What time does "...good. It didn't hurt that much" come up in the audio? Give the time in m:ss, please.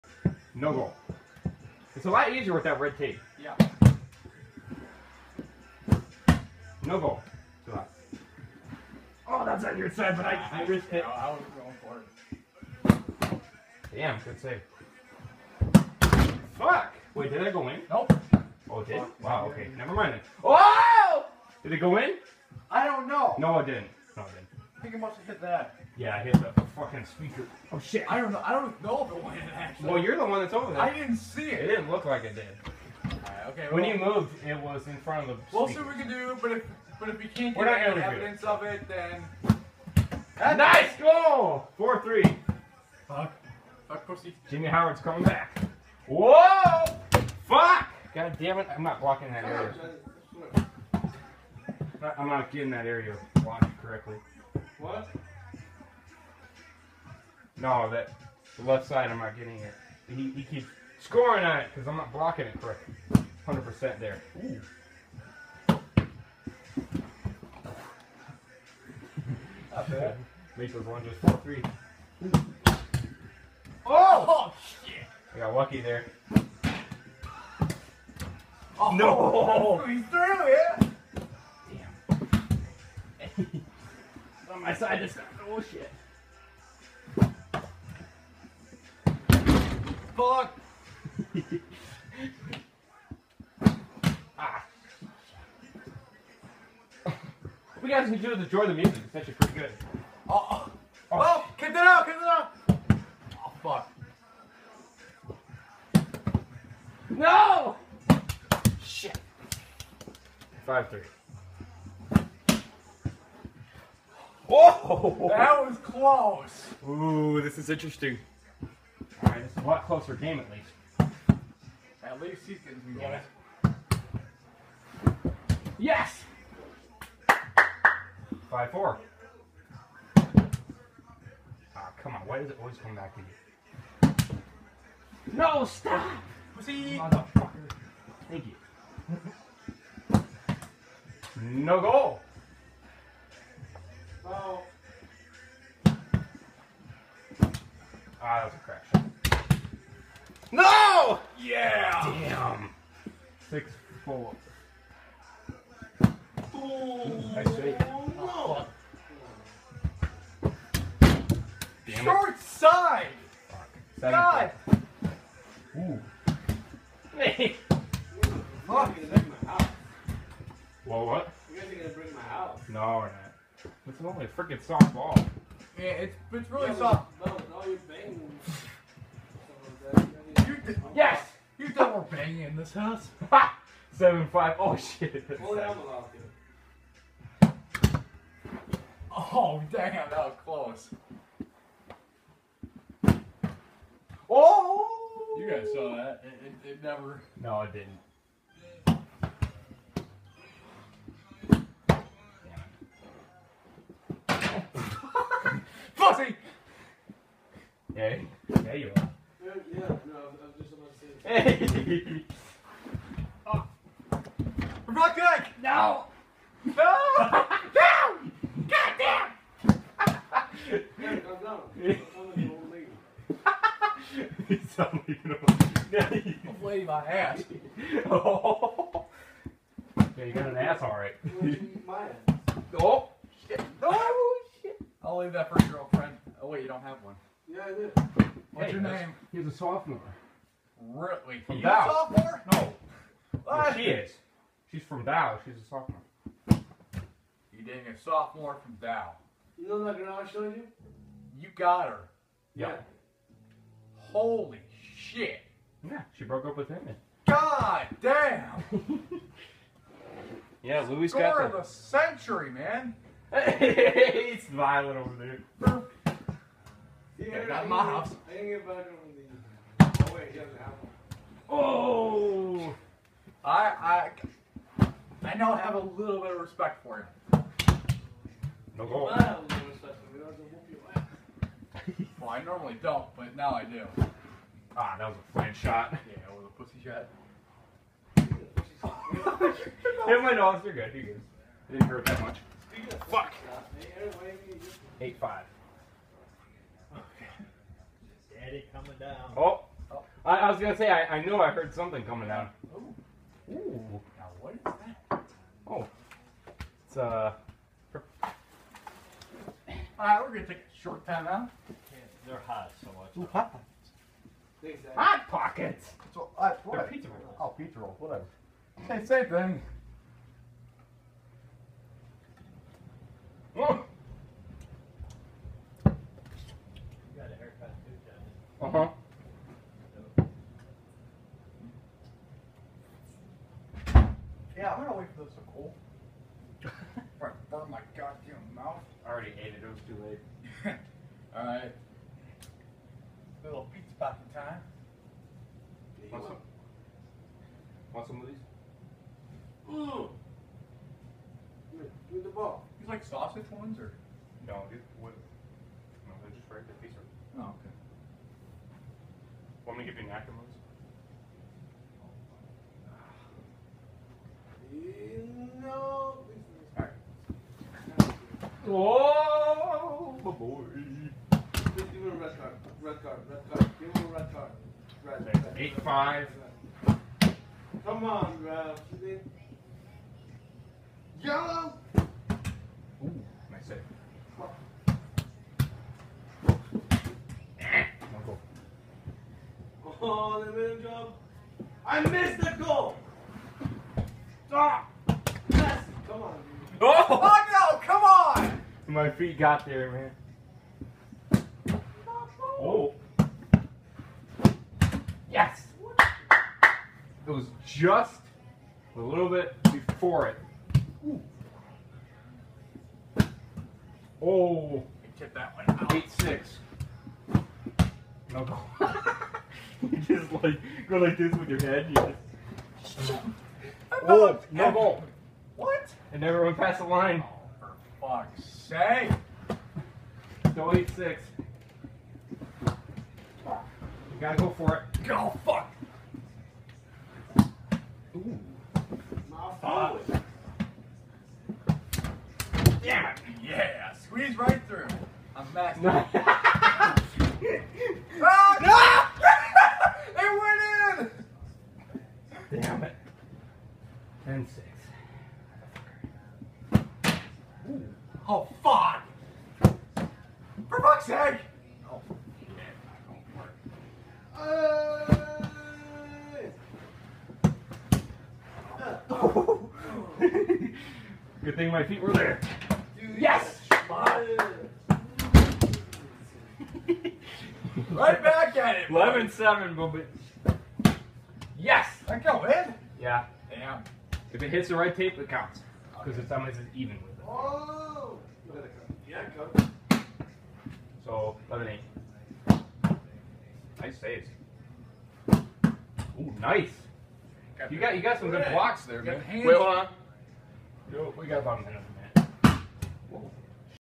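4:51.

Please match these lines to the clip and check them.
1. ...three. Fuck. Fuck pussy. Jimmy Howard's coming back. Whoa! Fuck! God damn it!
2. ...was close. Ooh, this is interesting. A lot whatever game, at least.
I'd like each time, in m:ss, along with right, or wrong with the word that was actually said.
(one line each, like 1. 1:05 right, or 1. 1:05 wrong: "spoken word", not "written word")
1. 0:42 right
2. 1:55 wrong: "closer", not "whatever".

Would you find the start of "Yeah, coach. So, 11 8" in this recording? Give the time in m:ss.
8:09.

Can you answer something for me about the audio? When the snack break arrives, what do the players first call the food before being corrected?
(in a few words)
hot pockets.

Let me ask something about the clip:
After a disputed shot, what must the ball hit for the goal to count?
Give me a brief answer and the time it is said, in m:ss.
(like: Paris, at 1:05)
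right tape, at 8:04.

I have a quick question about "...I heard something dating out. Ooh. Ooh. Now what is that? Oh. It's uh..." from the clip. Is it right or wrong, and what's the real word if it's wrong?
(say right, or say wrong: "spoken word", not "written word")
wrong: "coming", not "dating".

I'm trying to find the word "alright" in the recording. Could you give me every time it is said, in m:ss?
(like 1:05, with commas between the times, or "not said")
3:50, 5:09, 5:41.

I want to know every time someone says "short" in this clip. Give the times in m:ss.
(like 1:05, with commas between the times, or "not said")
2:42, 5:10.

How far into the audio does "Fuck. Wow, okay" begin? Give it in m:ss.
0:18.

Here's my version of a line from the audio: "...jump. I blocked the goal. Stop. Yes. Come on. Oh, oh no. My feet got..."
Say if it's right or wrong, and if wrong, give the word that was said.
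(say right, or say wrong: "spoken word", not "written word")
wrong: "missed", not "blocked".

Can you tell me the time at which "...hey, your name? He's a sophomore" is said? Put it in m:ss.
3:58.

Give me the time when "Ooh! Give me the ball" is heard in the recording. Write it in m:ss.
5:49.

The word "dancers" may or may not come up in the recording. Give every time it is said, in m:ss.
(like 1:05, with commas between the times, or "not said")
not said.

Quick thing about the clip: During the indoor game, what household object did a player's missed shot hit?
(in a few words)
speaker.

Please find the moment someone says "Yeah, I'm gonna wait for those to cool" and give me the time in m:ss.
5:34.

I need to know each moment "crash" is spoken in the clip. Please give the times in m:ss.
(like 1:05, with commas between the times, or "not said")
2:28.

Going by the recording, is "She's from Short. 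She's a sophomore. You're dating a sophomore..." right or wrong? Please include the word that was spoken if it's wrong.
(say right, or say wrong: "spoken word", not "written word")
wrong: "Bow", not "Short".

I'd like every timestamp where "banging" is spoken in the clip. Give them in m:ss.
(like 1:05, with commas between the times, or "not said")
2:57, 3:02.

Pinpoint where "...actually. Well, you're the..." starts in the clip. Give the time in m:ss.
0:29.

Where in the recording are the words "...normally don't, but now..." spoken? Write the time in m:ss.
4:42.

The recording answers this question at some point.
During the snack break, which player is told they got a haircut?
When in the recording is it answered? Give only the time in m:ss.
5:25.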